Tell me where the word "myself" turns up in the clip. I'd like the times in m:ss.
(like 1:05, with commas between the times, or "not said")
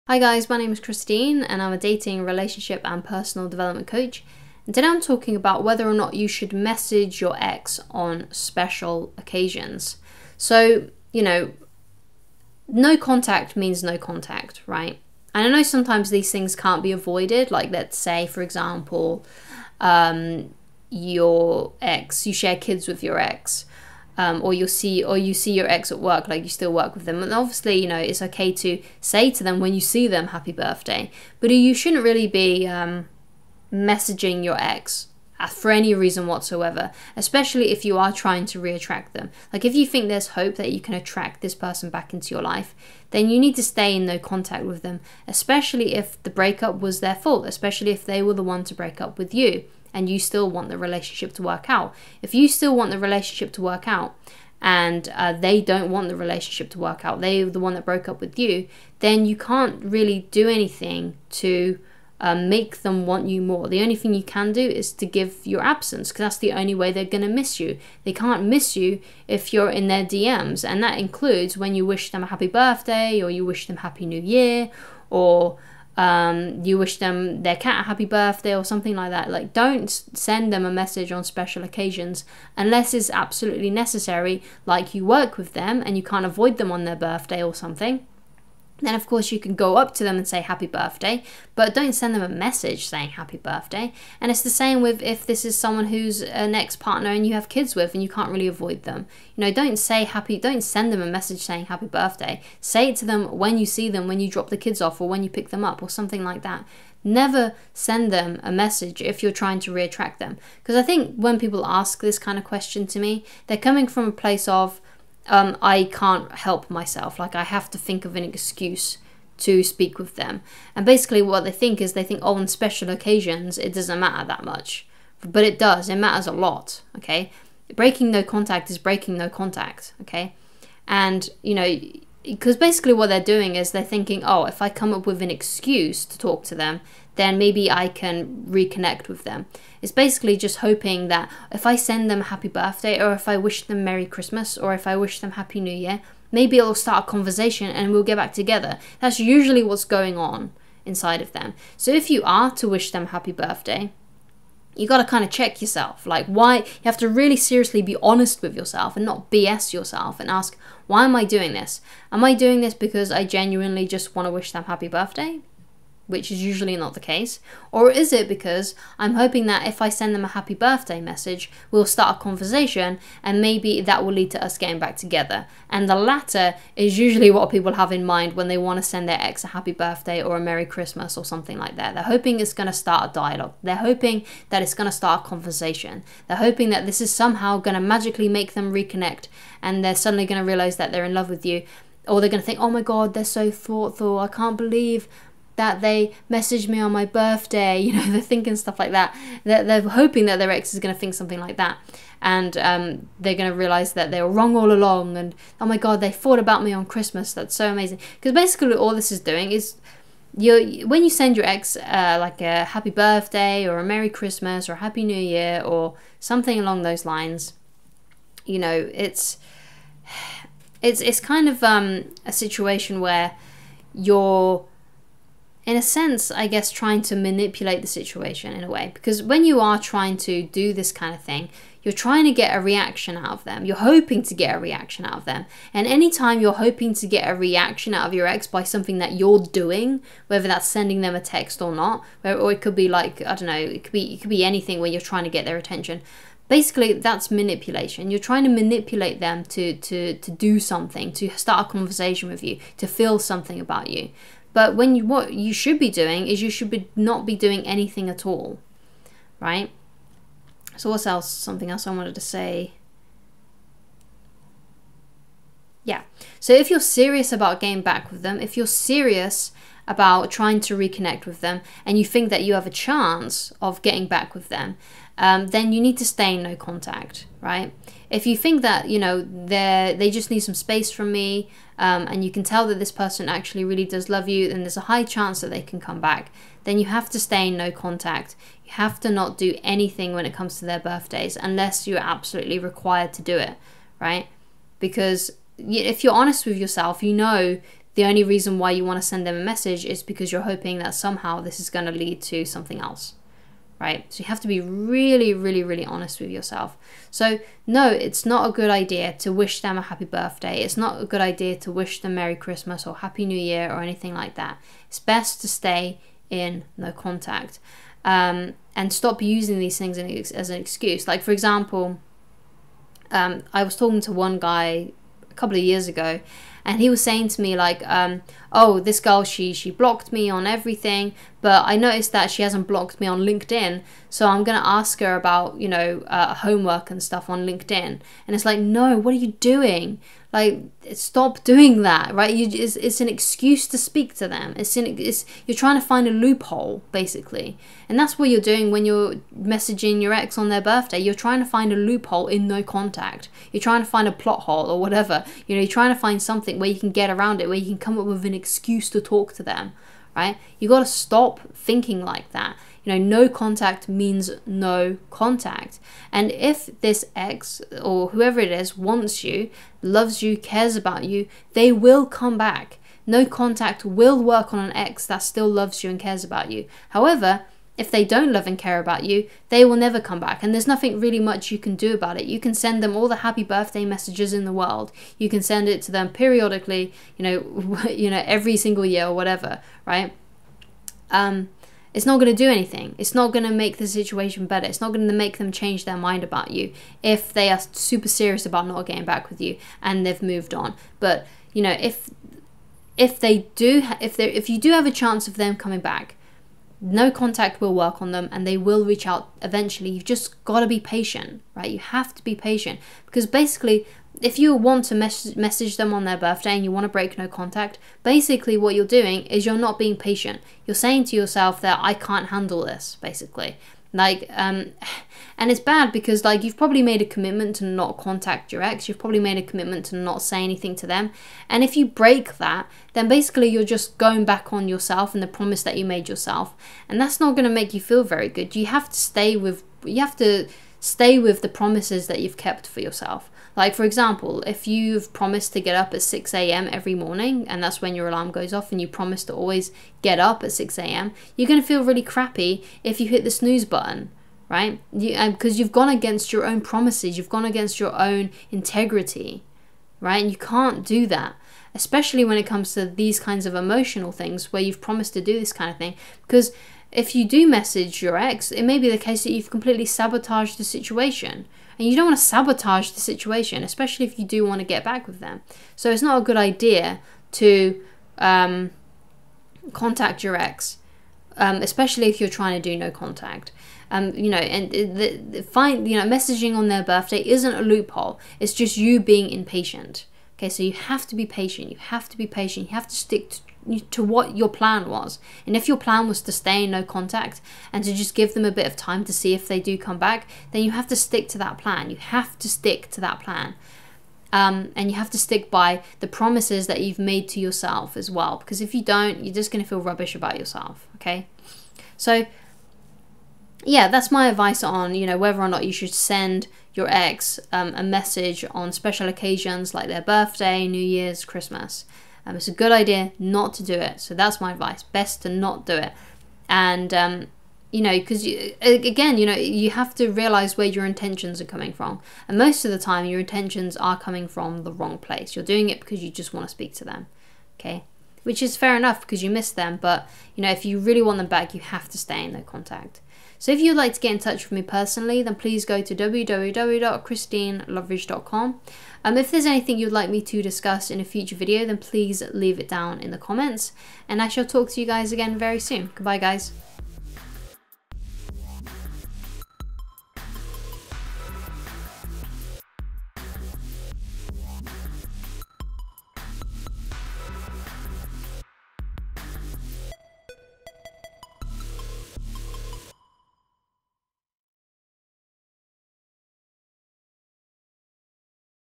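1:56.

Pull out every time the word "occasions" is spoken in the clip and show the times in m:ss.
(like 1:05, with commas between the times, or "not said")
0:09, 1:21, 2:02, 8:39.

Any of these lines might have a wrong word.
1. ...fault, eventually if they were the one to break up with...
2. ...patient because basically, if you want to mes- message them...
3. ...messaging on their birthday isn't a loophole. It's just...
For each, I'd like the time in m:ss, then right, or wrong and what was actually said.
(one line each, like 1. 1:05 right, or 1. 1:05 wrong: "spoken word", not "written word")
1. 0:47 wrong: "especially", not "eventually"
2. 6:52 right
3. 8:06 right.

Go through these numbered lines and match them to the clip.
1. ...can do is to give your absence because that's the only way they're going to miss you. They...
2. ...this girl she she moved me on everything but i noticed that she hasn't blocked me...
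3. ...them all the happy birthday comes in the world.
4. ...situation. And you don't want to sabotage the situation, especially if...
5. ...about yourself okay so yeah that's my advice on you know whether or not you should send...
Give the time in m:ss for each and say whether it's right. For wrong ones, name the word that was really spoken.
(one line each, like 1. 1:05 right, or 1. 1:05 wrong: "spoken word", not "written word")
1. 1:04 right
2. 5:28 wrong: "blocked", not "moved"
3. 6:22 wrong: "messages", not "comes"
4. 7:50 right
5. 8:30 right.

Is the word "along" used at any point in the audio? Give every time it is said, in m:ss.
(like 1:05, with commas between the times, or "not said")
3:24, 3:36.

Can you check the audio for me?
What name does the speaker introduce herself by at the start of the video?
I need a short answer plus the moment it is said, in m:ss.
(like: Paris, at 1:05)
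Christine, at 0:00.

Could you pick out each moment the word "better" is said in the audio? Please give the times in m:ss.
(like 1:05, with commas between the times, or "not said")
6:34.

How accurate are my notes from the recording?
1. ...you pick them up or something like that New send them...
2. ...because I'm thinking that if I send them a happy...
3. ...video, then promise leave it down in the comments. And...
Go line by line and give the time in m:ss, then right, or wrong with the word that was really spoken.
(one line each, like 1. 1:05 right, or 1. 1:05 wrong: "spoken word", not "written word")
1. 1:45 wrong: "Never", not "New"
2. 2:48 wrong: "hoping", not "thinking"
3. 9:11 wrong: "please", not "promise".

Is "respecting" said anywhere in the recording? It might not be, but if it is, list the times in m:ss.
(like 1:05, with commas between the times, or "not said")
not said.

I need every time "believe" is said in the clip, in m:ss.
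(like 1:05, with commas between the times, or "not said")
3:14.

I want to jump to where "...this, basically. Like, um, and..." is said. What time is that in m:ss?
7:02.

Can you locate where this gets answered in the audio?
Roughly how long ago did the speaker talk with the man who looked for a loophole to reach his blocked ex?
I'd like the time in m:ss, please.
5:25.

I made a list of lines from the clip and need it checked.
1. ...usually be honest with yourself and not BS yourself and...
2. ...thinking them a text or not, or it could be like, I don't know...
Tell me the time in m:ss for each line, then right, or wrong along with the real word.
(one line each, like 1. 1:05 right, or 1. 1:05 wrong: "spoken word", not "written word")
1. 2:37 wrong: "seriously", not "usually"
2. 4:00 wrong: "sending", not "thinking".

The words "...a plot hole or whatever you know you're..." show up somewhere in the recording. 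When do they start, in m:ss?
5:54.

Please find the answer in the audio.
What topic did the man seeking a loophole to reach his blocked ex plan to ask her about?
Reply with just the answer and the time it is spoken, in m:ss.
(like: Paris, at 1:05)
homework, at 5:36.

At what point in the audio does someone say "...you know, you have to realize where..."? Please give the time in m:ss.
8:49.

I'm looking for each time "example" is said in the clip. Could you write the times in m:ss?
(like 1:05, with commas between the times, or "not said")
0:18, 5:21, 7:23.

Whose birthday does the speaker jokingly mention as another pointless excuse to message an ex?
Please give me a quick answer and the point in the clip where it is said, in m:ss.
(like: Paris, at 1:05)
their cat, at 1:17.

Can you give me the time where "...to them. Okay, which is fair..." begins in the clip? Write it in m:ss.
8:56.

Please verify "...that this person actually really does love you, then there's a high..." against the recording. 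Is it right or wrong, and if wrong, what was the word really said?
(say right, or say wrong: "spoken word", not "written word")
right.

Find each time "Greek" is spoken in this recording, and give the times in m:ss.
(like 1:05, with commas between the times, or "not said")
not said.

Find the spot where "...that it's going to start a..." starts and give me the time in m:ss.
3:04.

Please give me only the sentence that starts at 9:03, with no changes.
So if you'd like to get in touch with me personally, then please go to www.christineloveridge.com.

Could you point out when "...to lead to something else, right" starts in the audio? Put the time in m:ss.
5:01.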